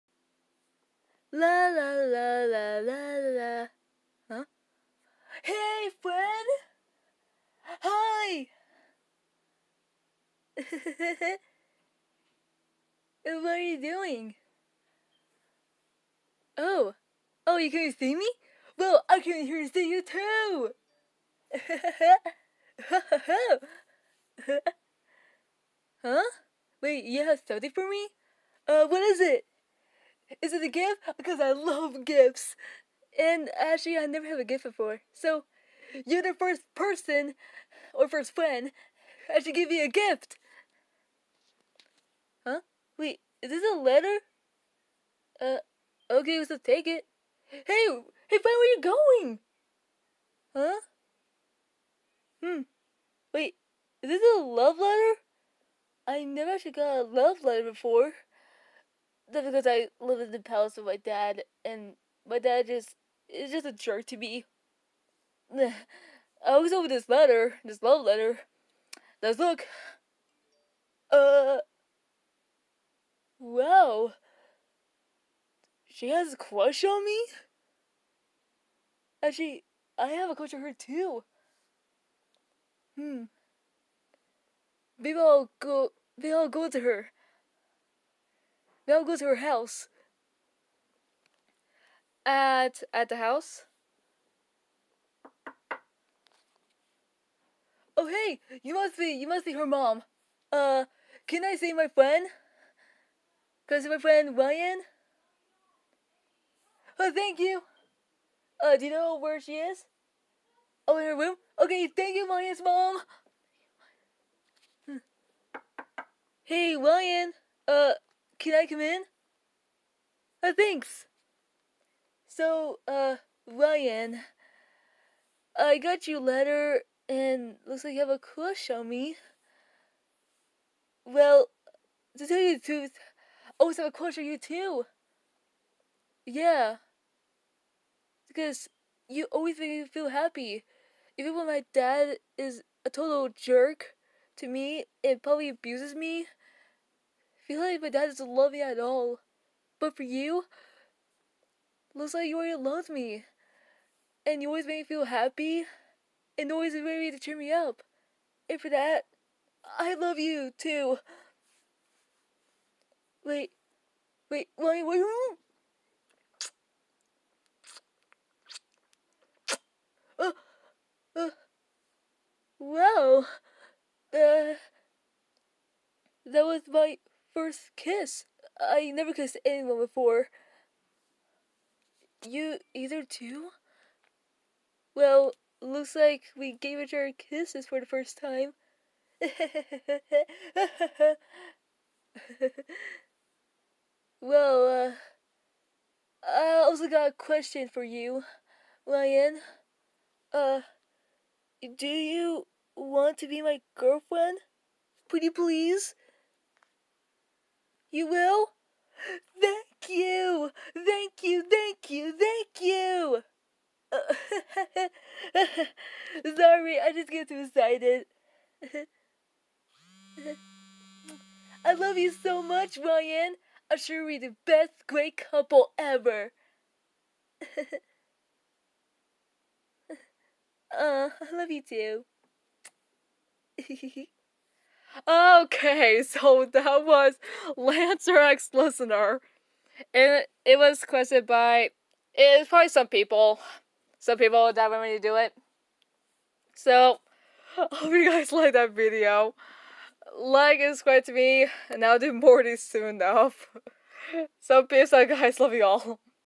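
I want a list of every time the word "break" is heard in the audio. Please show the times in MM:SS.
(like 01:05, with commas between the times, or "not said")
not said.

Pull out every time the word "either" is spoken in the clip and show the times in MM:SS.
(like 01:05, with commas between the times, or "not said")
03:02.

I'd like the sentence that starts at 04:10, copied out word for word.
Like and subscribe to me, and I'll do more of these soon enough.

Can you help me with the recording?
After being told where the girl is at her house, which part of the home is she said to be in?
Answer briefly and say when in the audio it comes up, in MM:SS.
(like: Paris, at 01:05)
her room, at 01:50.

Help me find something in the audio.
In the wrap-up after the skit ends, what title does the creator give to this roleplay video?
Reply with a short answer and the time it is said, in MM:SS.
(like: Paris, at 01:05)
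Lancer X Listener, at 03:57.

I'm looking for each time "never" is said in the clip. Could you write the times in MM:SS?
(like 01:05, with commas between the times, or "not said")
00:34, 00:56, 02:58.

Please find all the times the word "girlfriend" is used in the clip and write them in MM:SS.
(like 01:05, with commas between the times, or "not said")
03:23.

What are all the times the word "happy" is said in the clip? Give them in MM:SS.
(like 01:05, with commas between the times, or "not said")
02:20, 02:35.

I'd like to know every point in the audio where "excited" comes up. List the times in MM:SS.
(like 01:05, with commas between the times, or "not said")
03:37.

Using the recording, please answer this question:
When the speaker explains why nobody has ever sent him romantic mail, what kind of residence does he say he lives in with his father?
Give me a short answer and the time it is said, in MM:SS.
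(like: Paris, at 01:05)
palace, at 01:00.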